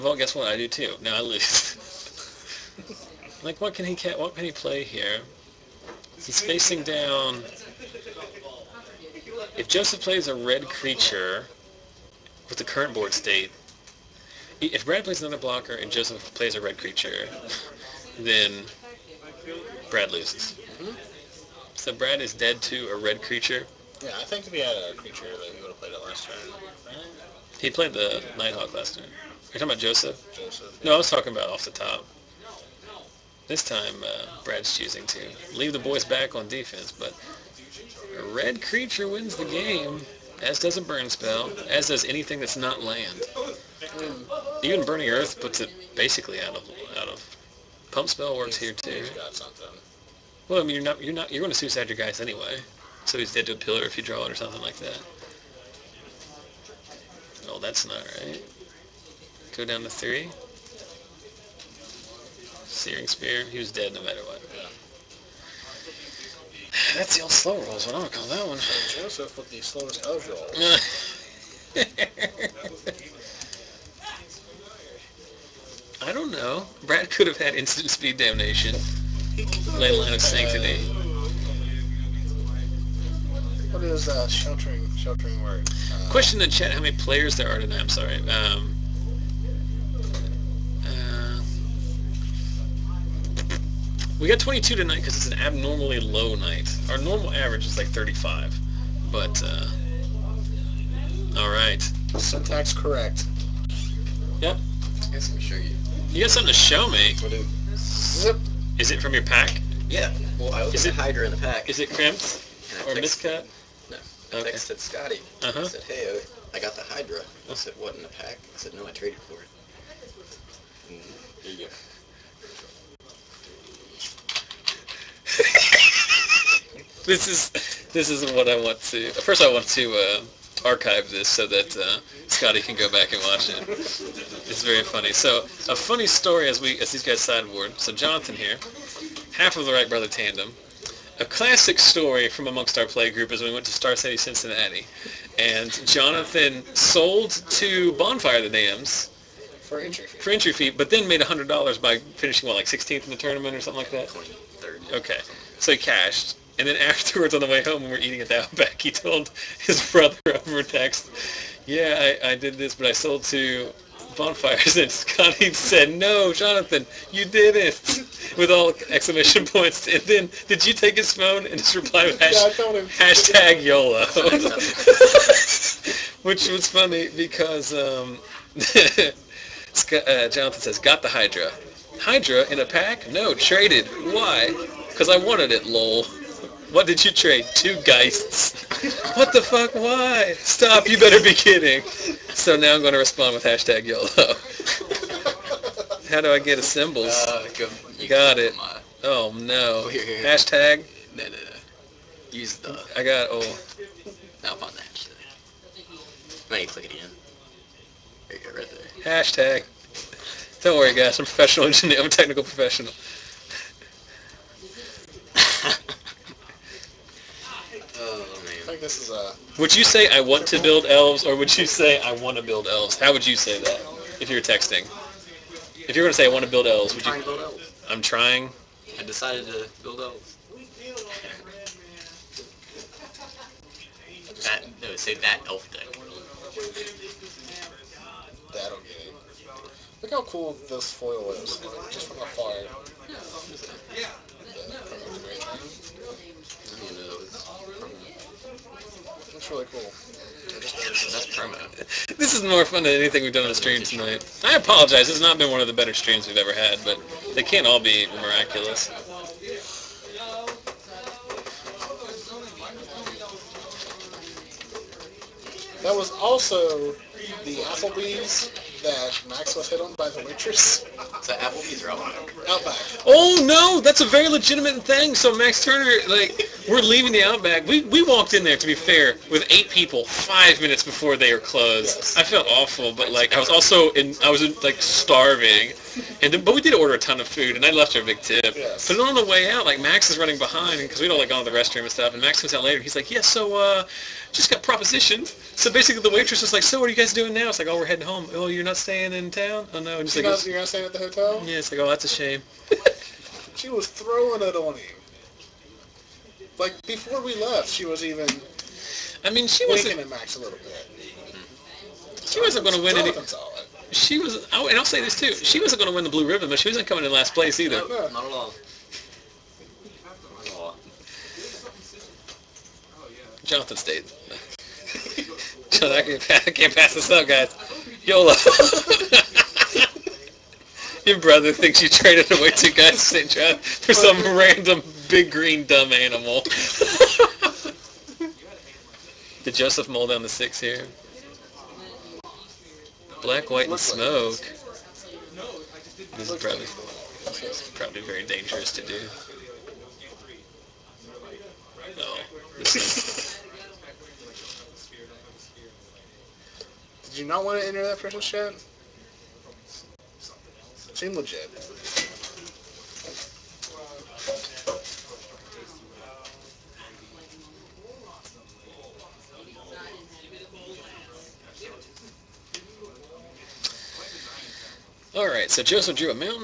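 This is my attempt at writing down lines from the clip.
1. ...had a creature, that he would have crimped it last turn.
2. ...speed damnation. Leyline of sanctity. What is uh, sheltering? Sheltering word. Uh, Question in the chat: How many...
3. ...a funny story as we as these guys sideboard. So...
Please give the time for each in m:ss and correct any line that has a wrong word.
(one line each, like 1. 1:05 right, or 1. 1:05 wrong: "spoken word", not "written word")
1. 0:24 wrong: "played", not "crimped"
2. 1:17 right
3. 2:15 right.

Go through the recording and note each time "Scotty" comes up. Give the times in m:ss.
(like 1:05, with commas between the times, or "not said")
1:54, 2:12, 2:44.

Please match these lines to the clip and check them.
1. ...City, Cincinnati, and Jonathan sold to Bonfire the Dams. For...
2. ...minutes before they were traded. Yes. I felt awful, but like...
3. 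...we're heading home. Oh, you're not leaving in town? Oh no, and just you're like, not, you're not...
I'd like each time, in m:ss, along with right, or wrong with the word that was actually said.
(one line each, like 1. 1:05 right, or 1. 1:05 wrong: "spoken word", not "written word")
1. 2:23 right
2. 4:40 wrong: "closed", not "traded"
3. 4:57 wrong: "staying", not "leaving".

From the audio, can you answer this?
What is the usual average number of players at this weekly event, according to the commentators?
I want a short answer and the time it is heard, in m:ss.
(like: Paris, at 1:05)
35, at 1:37.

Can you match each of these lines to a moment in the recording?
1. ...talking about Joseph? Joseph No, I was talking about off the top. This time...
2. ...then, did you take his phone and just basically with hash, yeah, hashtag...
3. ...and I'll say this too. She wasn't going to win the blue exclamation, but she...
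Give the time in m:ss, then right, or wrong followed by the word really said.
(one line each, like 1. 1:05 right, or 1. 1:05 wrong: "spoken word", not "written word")
1. 0:29 right
2. 2:50 wrong: "reply", not "basically"
3. 5:14 wrong: "ribbon", not "exclamation".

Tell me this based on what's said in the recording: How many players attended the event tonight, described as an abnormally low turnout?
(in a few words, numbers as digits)
22.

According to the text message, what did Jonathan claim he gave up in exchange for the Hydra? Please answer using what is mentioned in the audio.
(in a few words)
Two geists.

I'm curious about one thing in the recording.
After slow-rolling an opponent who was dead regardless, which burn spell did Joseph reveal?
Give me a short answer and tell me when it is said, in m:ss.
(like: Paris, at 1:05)
Searing Spear, at 1:02.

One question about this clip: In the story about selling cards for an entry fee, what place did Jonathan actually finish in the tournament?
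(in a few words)
23rd.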